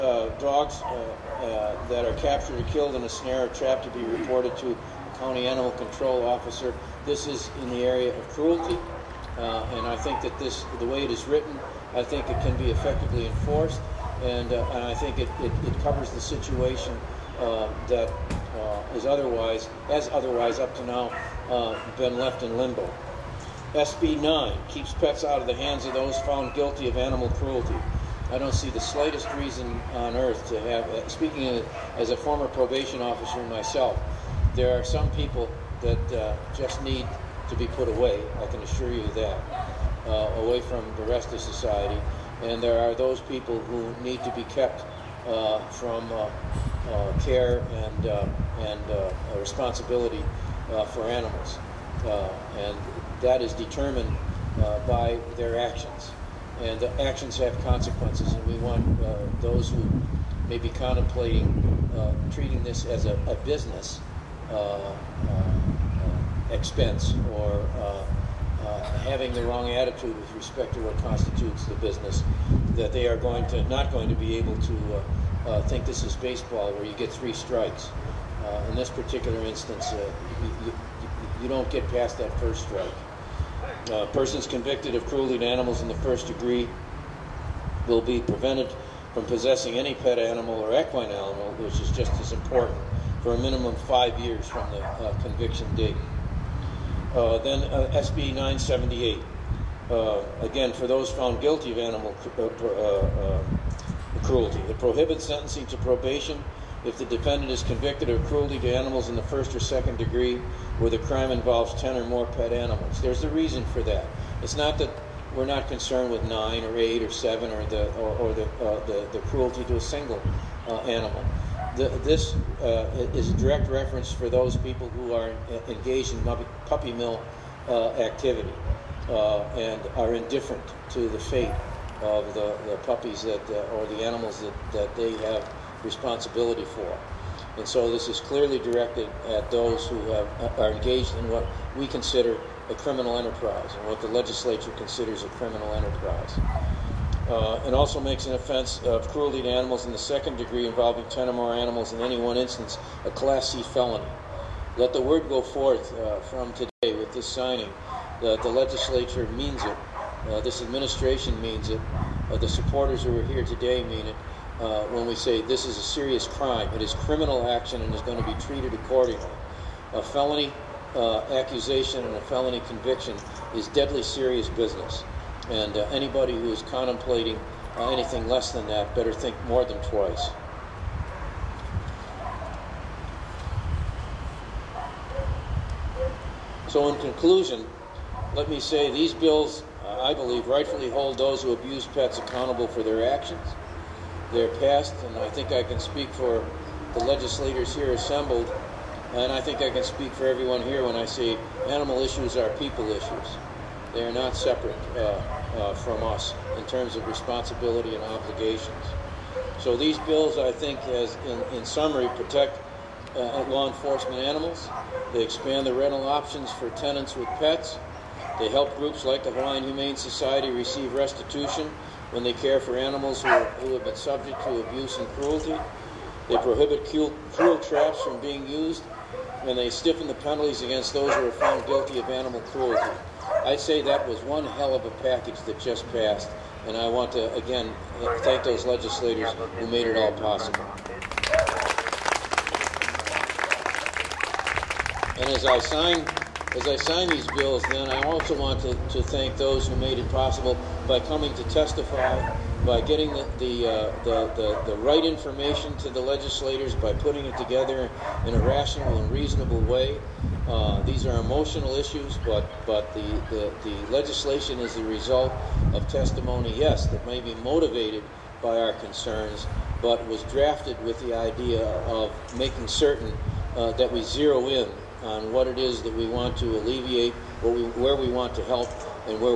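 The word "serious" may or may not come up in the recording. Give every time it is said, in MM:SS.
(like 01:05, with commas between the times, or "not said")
02:45, 02:54.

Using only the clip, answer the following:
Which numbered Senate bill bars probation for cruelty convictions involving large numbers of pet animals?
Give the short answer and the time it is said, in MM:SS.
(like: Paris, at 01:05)
SB 978, at 01:37.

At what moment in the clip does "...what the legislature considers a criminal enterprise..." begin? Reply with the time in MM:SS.
02:23.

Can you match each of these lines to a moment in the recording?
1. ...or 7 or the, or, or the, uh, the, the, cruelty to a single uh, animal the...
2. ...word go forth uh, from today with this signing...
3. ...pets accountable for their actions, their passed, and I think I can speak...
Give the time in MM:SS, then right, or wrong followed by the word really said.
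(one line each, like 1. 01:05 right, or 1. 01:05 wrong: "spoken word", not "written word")
1. 01:57 right
2. 02:35 right
3. 03:11 right.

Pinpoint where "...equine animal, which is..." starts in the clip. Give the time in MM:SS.
01:30.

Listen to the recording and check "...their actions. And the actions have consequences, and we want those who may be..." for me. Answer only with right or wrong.
right.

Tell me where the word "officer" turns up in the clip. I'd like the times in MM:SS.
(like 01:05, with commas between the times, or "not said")
00:06, 00:33.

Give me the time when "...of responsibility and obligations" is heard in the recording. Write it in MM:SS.
03:26.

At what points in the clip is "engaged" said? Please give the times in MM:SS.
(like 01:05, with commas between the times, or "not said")
02:05, 02:20.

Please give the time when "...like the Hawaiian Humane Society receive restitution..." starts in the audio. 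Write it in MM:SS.
03:39.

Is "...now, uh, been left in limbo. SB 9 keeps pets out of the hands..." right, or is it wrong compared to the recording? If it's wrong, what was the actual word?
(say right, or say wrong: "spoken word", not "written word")
right.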